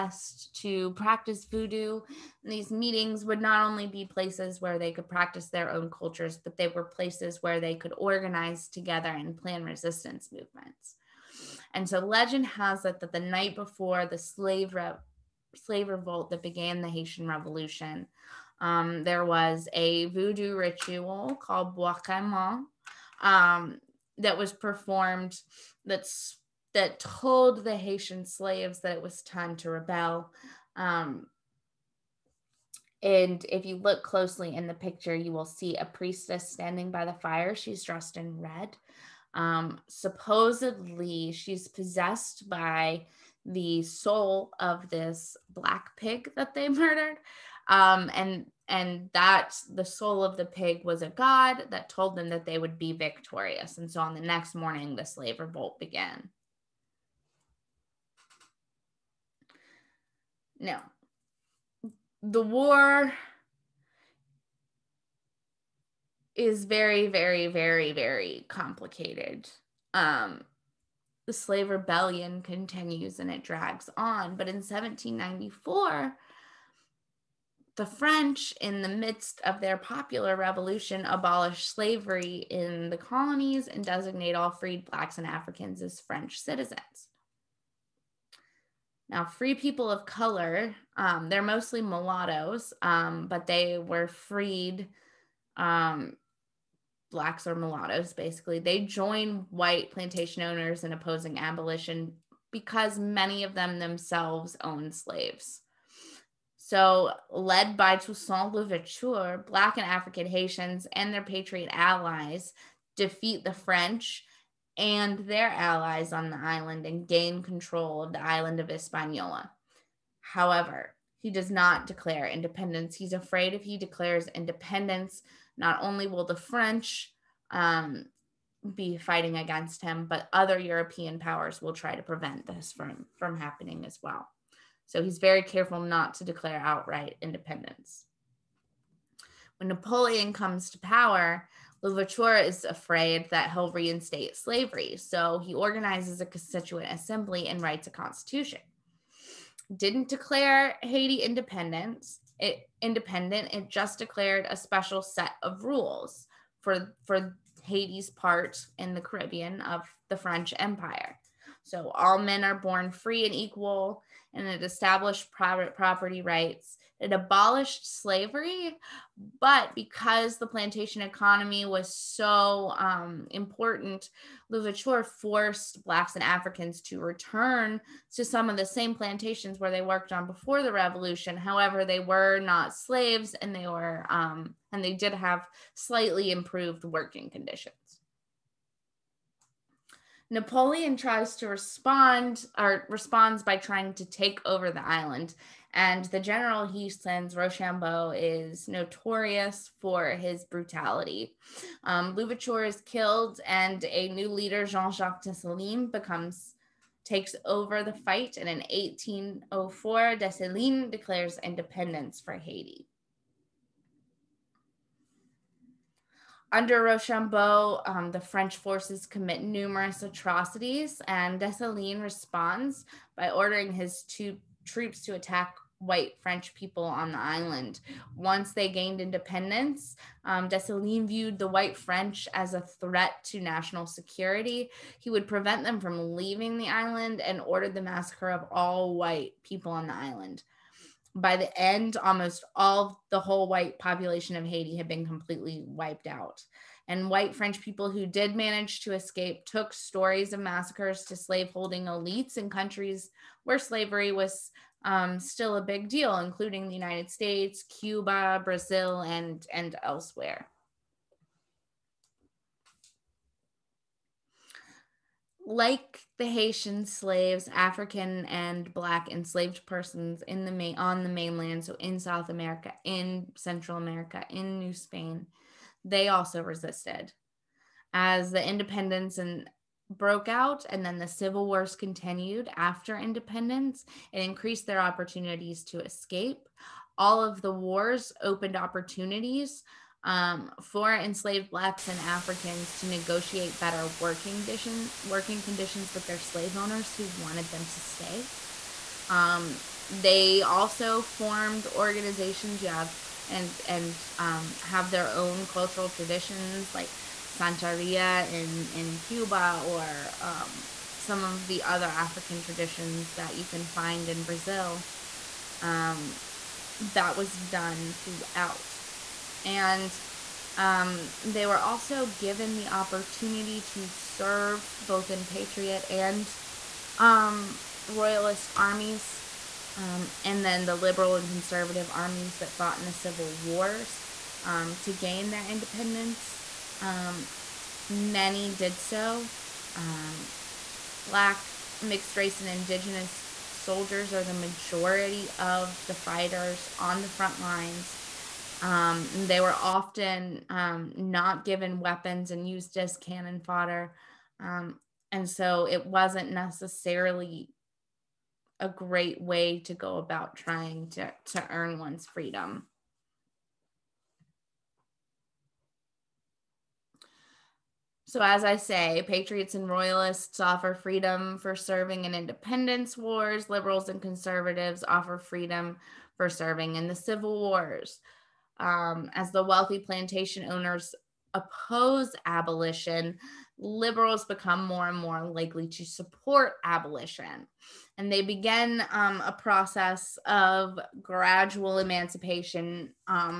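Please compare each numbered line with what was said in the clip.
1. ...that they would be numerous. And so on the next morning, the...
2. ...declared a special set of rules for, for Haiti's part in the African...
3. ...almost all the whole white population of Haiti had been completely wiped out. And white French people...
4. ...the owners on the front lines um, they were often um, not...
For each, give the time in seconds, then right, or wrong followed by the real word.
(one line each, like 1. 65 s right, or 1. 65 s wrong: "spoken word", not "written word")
1. 52 s wrong: "victorious", not "numerous"
2. 153 s wrong: "Caribbean", not "African"
3. 241 s right
4. 345 s wrong: "fighters", not "owners".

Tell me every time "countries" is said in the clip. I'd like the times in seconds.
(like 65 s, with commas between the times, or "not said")
252 s.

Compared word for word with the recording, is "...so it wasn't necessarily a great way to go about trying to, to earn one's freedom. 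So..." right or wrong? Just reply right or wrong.
right.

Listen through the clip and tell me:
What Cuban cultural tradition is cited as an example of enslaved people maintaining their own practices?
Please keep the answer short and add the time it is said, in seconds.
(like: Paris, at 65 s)
Santeria, at 307 s.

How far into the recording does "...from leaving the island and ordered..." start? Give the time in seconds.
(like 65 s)
235 s.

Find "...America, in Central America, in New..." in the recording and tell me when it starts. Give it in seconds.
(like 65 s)
272 s.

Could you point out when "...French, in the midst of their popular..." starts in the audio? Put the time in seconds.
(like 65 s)
77 s.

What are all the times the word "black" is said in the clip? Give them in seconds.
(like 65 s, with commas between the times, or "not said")
45 s, 84 s, 97 s, 109 s, 175 s, 268 s, 291 s, 341 s.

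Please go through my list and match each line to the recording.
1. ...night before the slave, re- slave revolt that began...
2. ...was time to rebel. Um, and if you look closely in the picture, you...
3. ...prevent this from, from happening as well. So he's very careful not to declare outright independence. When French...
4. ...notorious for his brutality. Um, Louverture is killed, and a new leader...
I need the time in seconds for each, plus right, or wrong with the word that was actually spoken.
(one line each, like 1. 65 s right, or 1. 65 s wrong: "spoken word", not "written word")
1. 13 s right
2. 29 s right
3. 132 s wrong: "Napoleon", not "French"
4. 198 s right.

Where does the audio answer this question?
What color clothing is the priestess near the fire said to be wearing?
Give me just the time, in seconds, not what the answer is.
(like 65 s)
38 s.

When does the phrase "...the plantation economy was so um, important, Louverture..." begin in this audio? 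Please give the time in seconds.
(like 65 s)
170 s.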